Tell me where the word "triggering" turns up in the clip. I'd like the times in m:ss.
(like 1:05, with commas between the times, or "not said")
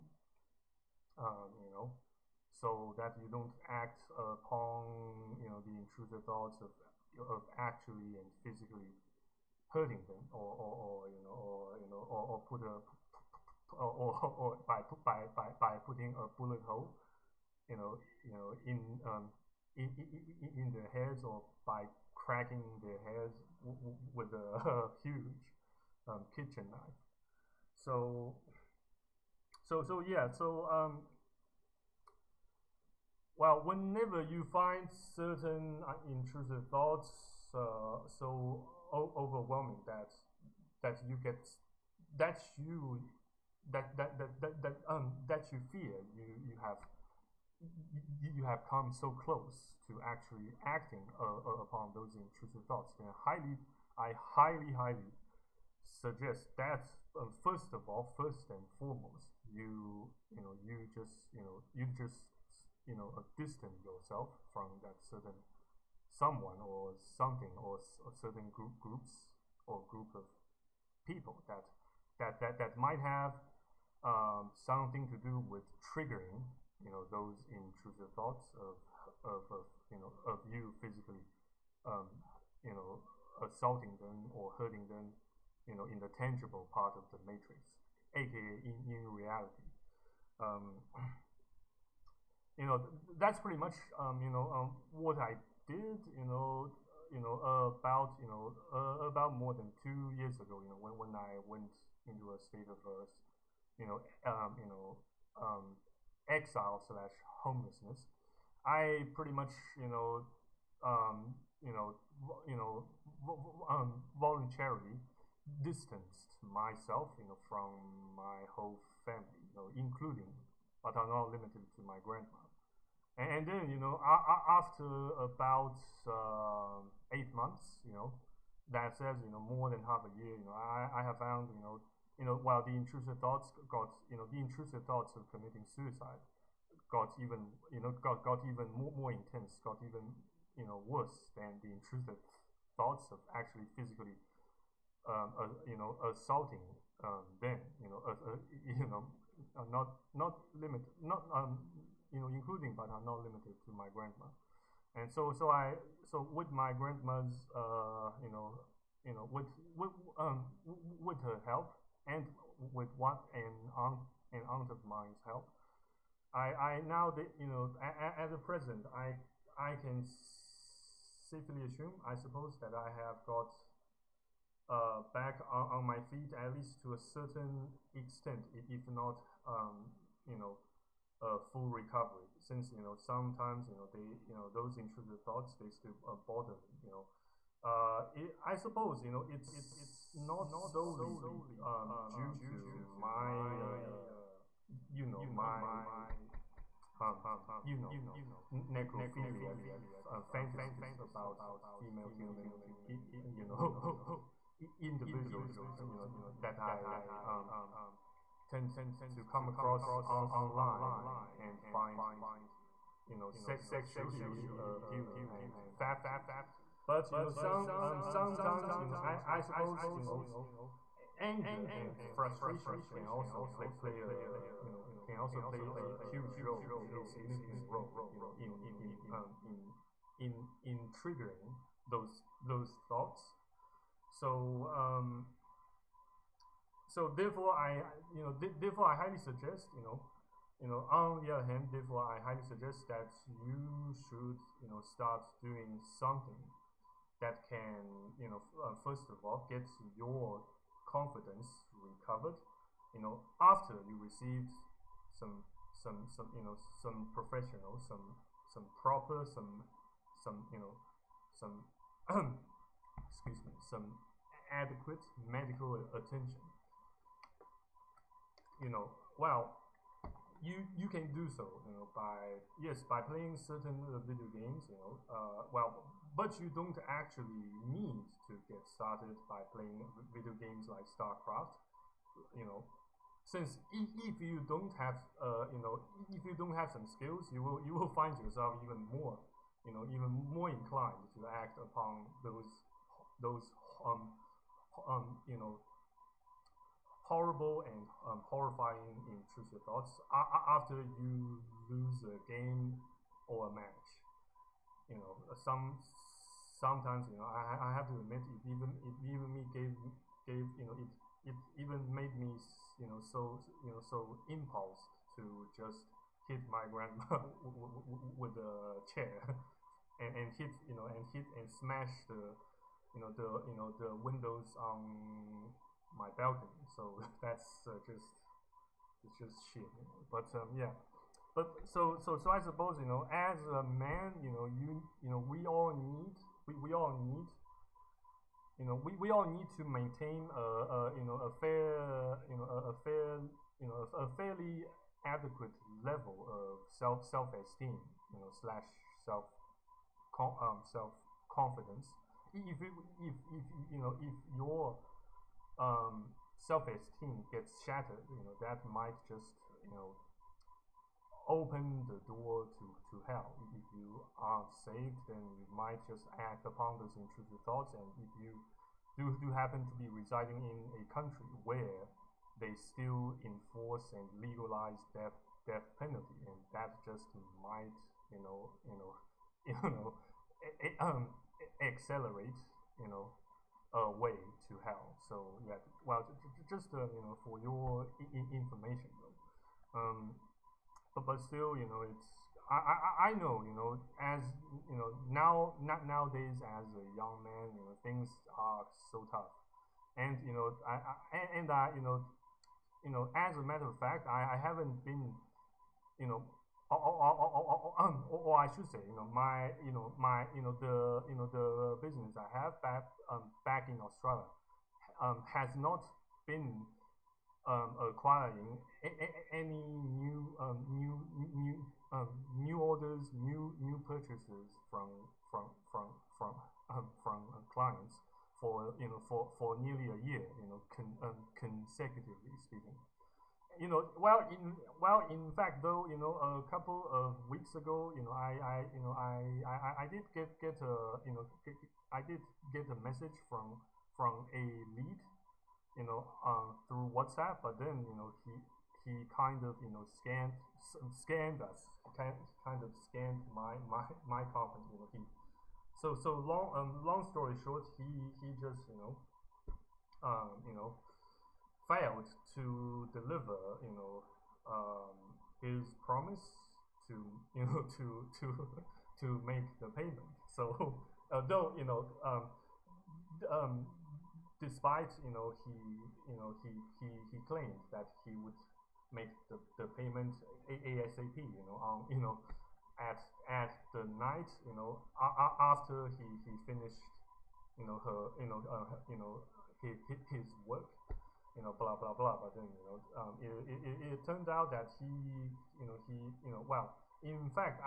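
1:15, 3:50.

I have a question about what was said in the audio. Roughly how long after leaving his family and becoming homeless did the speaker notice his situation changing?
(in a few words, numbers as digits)
8 months.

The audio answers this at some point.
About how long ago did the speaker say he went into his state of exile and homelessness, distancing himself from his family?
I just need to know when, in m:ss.
1:39.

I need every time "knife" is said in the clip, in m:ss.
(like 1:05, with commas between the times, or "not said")
0:26.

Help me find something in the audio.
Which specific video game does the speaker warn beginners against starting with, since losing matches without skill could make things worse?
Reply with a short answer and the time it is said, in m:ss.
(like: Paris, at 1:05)
StarCraft, at 4:40.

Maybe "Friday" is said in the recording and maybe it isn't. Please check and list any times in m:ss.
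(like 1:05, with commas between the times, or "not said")
not said.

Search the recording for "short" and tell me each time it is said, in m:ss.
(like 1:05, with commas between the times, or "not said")
7:37.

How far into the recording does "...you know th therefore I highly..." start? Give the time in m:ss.
3:58.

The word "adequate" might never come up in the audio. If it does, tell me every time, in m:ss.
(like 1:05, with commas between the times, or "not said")
4:24, 5:45.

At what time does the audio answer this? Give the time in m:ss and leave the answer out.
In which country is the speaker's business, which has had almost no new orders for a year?
6:53.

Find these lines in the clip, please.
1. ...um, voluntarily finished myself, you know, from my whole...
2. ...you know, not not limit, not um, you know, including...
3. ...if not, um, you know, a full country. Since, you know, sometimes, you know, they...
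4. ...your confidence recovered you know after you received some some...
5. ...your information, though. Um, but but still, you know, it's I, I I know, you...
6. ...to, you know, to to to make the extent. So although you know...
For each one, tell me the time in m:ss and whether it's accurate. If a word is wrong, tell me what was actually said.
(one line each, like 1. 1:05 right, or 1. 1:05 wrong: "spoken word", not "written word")
1. 1:53 wrong: "distanced", not "finished"
2. 2:28 right
3. 2:58 wrong: "recovery", not "country"
4. 4:09 right
5. 6:27 right
6. 7:46 wrong: "payment", not "extent".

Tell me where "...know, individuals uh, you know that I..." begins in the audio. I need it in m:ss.
3:23.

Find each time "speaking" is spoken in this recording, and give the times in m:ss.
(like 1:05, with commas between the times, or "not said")
7:12.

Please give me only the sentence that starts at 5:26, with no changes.
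So that's uh, just it's just shit.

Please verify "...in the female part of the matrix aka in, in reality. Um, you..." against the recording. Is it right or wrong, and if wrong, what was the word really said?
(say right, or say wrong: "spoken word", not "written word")
wrong: "tangible", not "female".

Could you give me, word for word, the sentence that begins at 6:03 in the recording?
If you are saved, then you might just act upon those intrusive thoughts.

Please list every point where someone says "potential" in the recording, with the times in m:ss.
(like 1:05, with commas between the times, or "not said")
not said.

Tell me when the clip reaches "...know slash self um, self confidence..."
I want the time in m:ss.
5:48.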